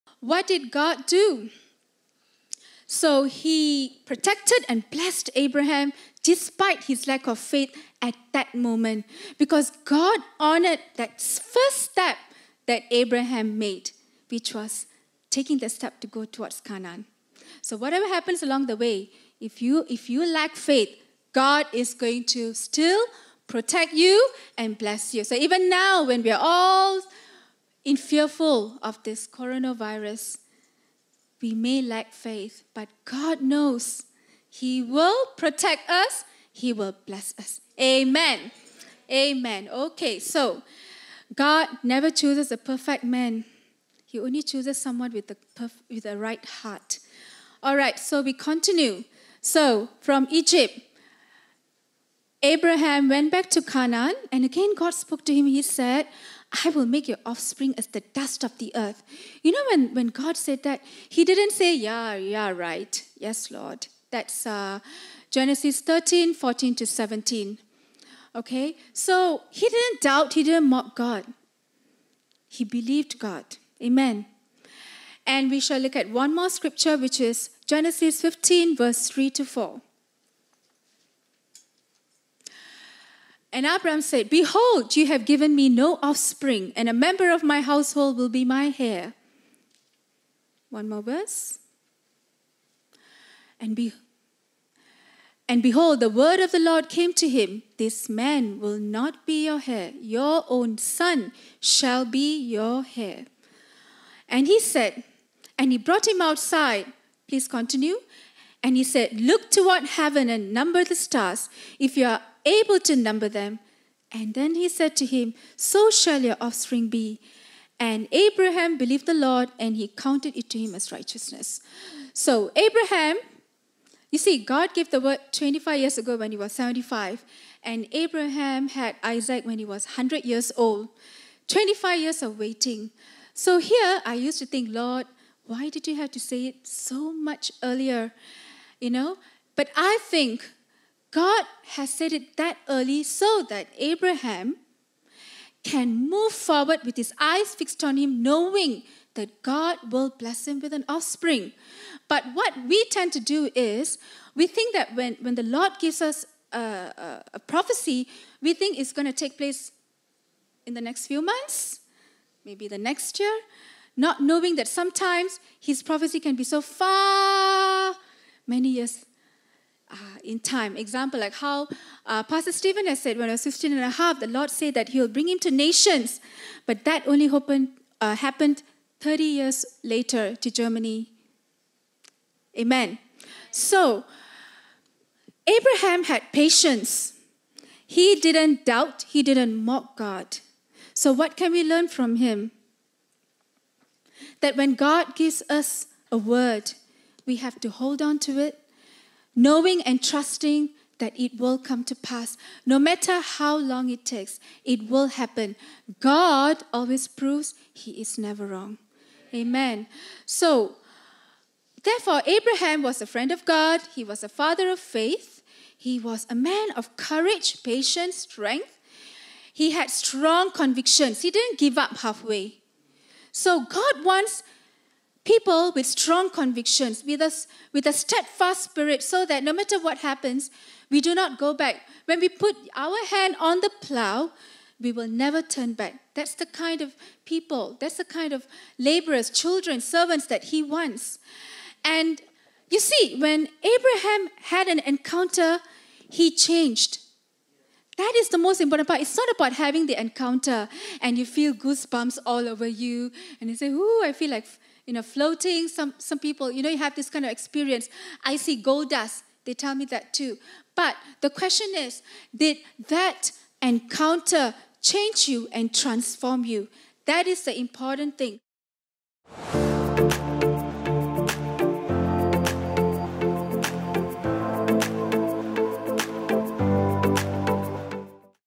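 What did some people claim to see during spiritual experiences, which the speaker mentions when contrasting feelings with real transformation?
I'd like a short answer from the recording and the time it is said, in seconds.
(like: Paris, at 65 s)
Gold dust, at 258 s.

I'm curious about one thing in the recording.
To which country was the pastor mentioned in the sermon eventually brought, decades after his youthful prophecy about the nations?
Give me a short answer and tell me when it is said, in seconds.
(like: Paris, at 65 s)
Germany, at 180 s.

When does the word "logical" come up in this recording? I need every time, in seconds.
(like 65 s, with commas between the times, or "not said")
not said.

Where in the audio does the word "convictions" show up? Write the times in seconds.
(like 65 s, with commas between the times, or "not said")
220 s, 226 s.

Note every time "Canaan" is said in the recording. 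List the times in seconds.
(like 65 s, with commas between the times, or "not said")
16 s, 53 s.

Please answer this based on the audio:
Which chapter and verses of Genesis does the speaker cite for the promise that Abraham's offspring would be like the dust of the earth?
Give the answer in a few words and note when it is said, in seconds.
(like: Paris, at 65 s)
Genesis 13:14-17, at 65 s.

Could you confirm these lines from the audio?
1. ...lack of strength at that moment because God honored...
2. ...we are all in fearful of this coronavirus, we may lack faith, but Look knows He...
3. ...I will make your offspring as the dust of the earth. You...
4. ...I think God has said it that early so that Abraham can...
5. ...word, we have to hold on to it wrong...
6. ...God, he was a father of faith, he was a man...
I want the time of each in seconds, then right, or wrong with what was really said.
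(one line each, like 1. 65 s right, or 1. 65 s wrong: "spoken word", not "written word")
1. 7 s wrong: "faith", not "strength"
2. 26 s wrong: "God", not "Look"
3. 56 s right
4. 139 s right
5. 196 s wrong: "knowing", not "wrong"
6. 213 s right.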